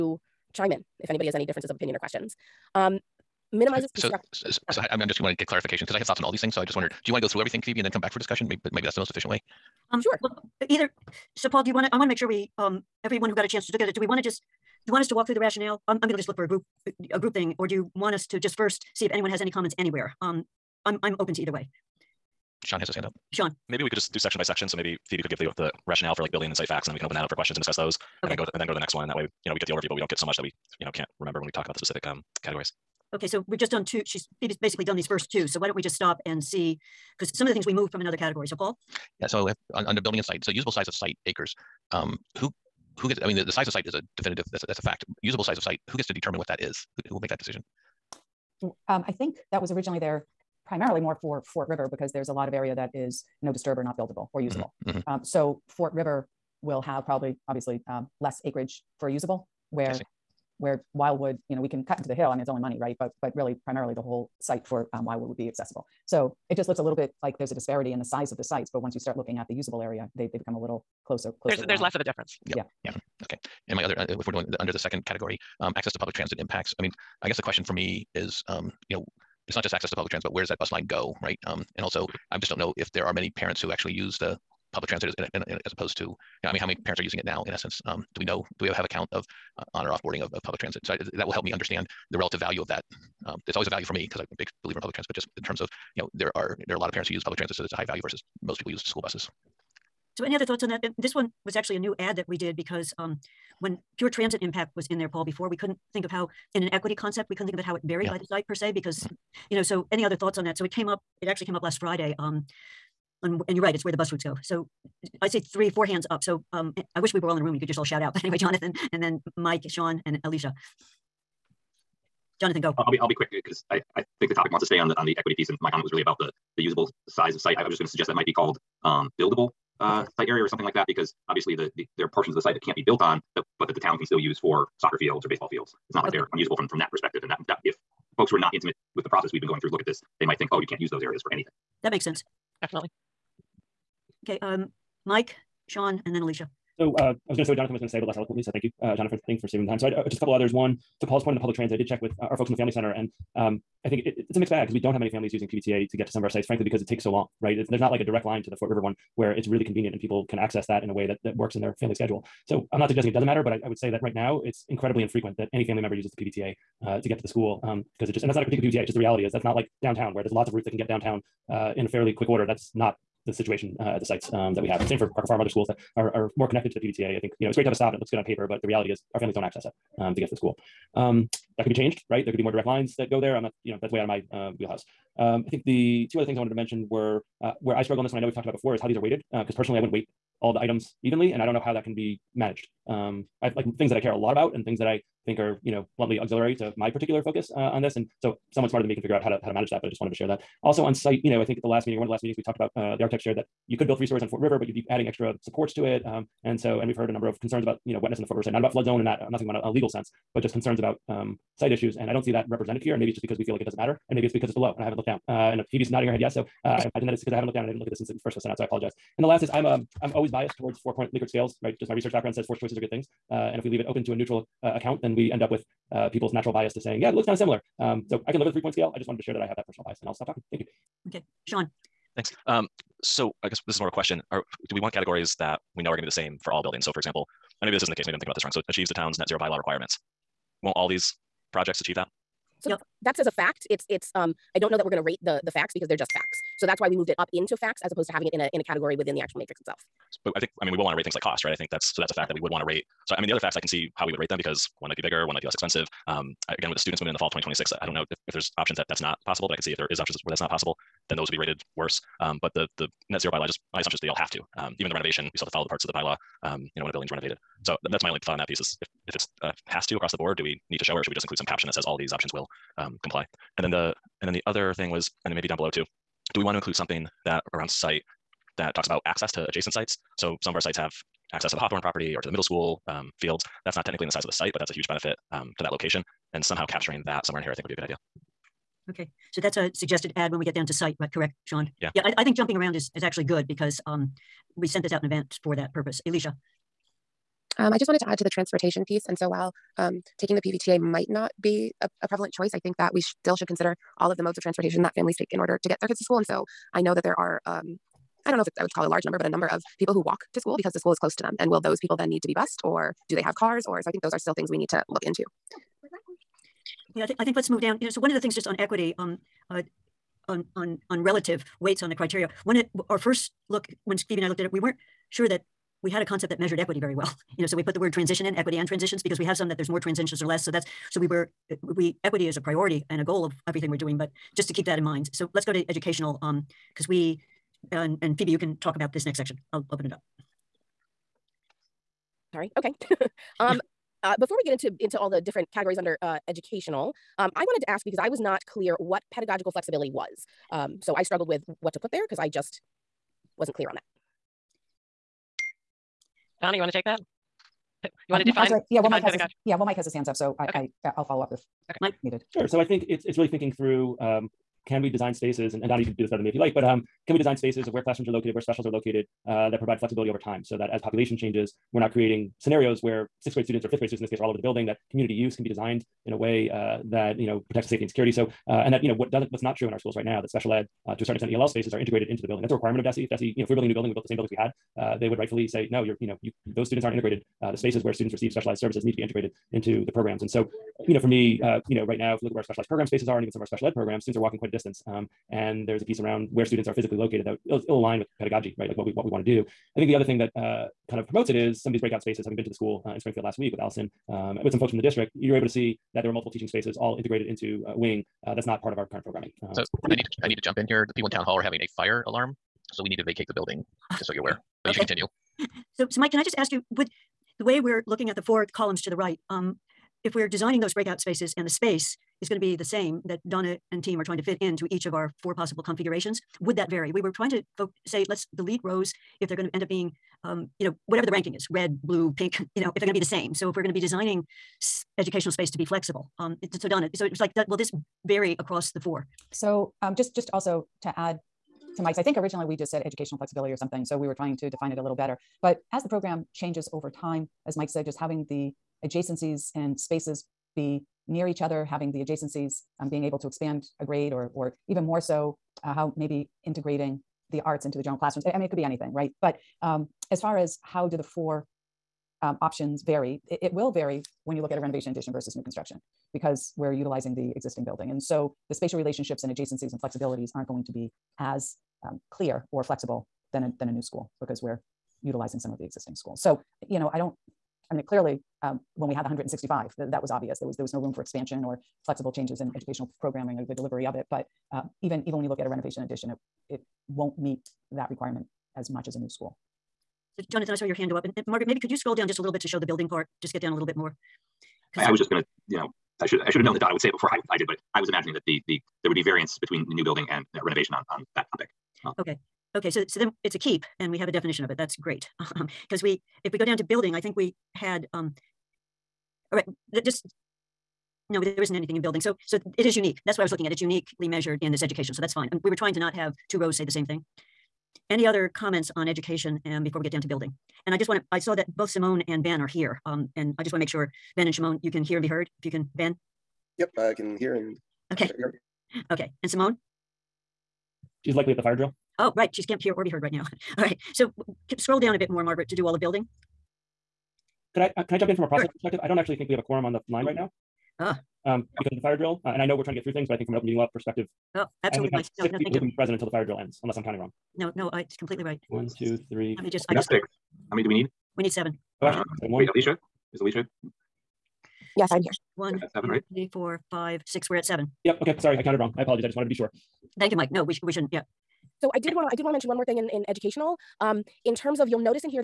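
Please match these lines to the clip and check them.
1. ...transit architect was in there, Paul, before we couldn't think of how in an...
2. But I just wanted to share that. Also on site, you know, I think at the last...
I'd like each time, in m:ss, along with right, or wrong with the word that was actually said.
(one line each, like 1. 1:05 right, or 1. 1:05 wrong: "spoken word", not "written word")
1. 1:44 wrong: "impact", not "architect"
2. 3:19 right.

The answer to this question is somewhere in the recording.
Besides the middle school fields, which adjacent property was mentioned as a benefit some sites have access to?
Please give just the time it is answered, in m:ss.
4:41.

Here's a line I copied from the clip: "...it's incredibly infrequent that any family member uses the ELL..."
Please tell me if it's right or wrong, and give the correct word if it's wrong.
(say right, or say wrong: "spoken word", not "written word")
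wrong: "PVTA", not "ELL".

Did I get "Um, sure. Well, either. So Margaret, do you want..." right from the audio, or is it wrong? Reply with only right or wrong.
wrong.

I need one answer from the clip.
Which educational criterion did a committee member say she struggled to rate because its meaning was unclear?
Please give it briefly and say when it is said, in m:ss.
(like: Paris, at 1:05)
pedagogical flexibility, at 5:49.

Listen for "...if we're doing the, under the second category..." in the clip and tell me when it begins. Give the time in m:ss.
1:14.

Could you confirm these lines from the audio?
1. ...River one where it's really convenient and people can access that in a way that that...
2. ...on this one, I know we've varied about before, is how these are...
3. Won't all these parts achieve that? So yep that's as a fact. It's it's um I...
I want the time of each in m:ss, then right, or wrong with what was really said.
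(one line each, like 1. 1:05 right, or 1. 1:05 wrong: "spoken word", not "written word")
1. 2:38 right
2. 3:07 wrong: "talked", not "varied"
3. 4:00 wrong: "projects", not "parts".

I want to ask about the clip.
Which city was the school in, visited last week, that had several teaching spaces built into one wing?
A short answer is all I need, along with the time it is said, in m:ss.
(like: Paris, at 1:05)
Springfield, at 6:42.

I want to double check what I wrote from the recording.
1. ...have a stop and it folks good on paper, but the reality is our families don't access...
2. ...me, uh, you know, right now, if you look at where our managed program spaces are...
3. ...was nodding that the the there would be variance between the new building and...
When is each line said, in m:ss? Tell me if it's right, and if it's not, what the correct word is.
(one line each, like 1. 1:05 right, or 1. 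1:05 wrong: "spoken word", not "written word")
1. 2:57 wrong: "looks", not "folks"
2. 6:31 wrong: "specialized", not "managed"
3. 8:17 wrong: "imagining", not "nodding".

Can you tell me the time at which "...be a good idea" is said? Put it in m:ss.
4:47.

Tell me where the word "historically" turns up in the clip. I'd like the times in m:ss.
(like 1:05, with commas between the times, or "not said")
not said.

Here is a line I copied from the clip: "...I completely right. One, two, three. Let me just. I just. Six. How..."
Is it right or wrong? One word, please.
right.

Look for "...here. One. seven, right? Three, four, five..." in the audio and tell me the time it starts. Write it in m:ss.
9:15.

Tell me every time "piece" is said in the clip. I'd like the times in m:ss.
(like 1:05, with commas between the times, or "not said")
2:05, 4:28, 4:58, 6:35.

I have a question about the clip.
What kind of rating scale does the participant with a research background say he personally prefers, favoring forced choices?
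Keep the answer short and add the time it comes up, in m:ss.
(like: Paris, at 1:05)
four point Likert scales, at 3:40.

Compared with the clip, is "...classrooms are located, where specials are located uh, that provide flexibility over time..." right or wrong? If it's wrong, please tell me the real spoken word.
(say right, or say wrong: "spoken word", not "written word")
right.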